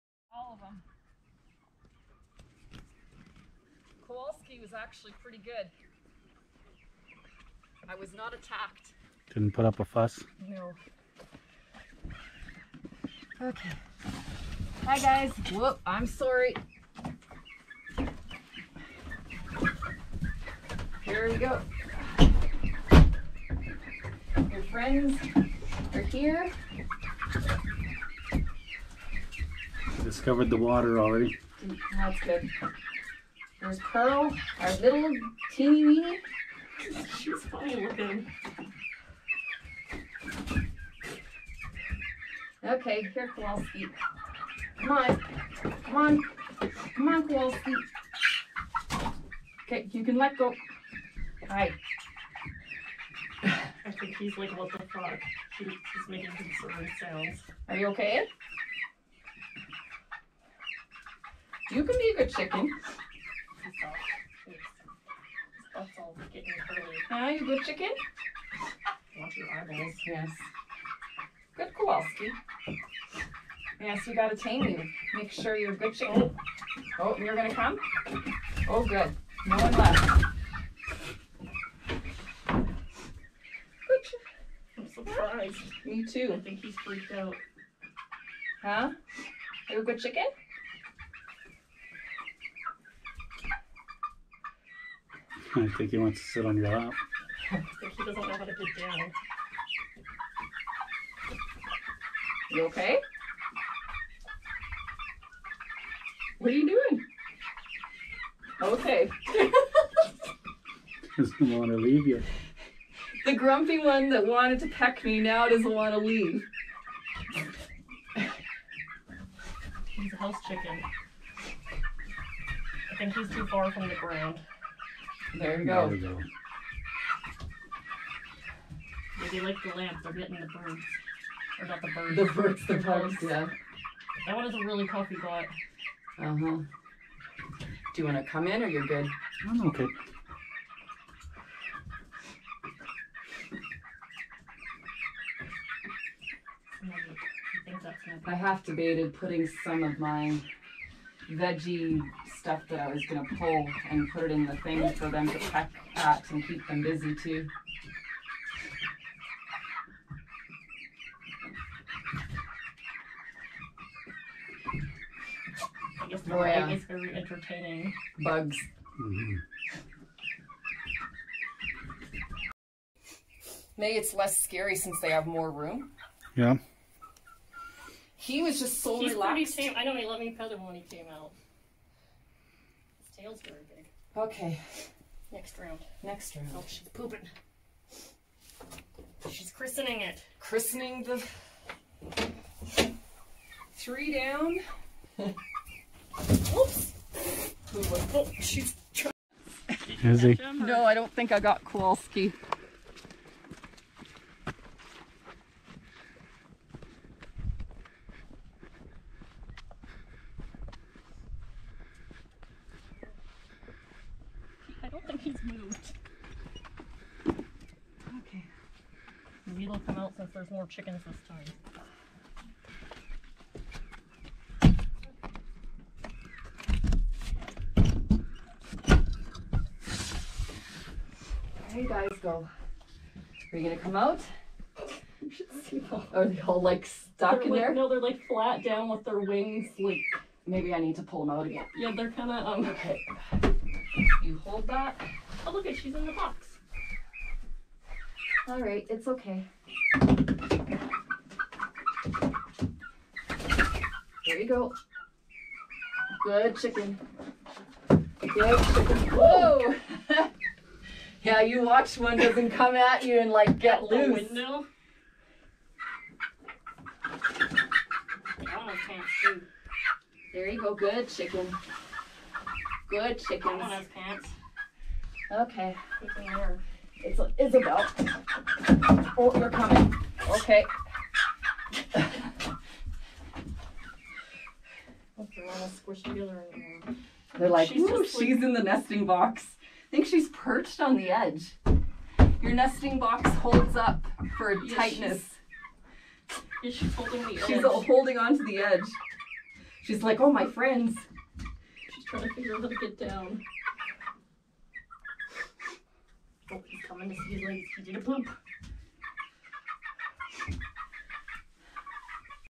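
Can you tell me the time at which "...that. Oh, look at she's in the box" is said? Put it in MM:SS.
04:04.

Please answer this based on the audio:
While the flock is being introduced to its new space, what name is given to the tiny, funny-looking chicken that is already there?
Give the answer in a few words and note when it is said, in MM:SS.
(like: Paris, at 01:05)
Pearl, at 00:33.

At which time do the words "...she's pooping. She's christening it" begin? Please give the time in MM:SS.
03:06.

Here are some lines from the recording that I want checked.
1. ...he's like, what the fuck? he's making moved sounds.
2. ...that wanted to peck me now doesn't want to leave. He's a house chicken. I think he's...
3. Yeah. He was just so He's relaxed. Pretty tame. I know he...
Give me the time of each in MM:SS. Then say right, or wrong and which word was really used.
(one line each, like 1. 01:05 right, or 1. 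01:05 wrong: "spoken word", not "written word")
1. 00:54 wrong: "concerned", not "moved"
2. 01:54 right
3. 02:56 right.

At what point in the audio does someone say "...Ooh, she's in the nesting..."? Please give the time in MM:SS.
04:47.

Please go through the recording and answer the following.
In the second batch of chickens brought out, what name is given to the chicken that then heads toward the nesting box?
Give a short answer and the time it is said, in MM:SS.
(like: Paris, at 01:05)
Isabel, at 04:37.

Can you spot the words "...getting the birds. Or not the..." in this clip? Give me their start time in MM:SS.
02:10.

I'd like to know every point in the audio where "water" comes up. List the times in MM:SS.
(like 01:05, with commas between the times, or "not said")
00:30.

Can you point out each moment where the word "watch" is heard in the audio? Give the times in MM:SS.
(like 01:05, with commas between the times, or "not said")
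01:09, 04:21.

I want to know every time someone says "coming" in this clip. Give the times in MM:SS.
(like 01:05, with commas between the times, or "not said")
04:39, 05:06.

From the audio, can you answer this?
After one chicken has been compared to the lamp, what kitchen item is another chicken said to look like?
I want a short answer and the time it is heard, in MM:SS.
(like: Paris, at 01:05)
coffee pot, at 02:14.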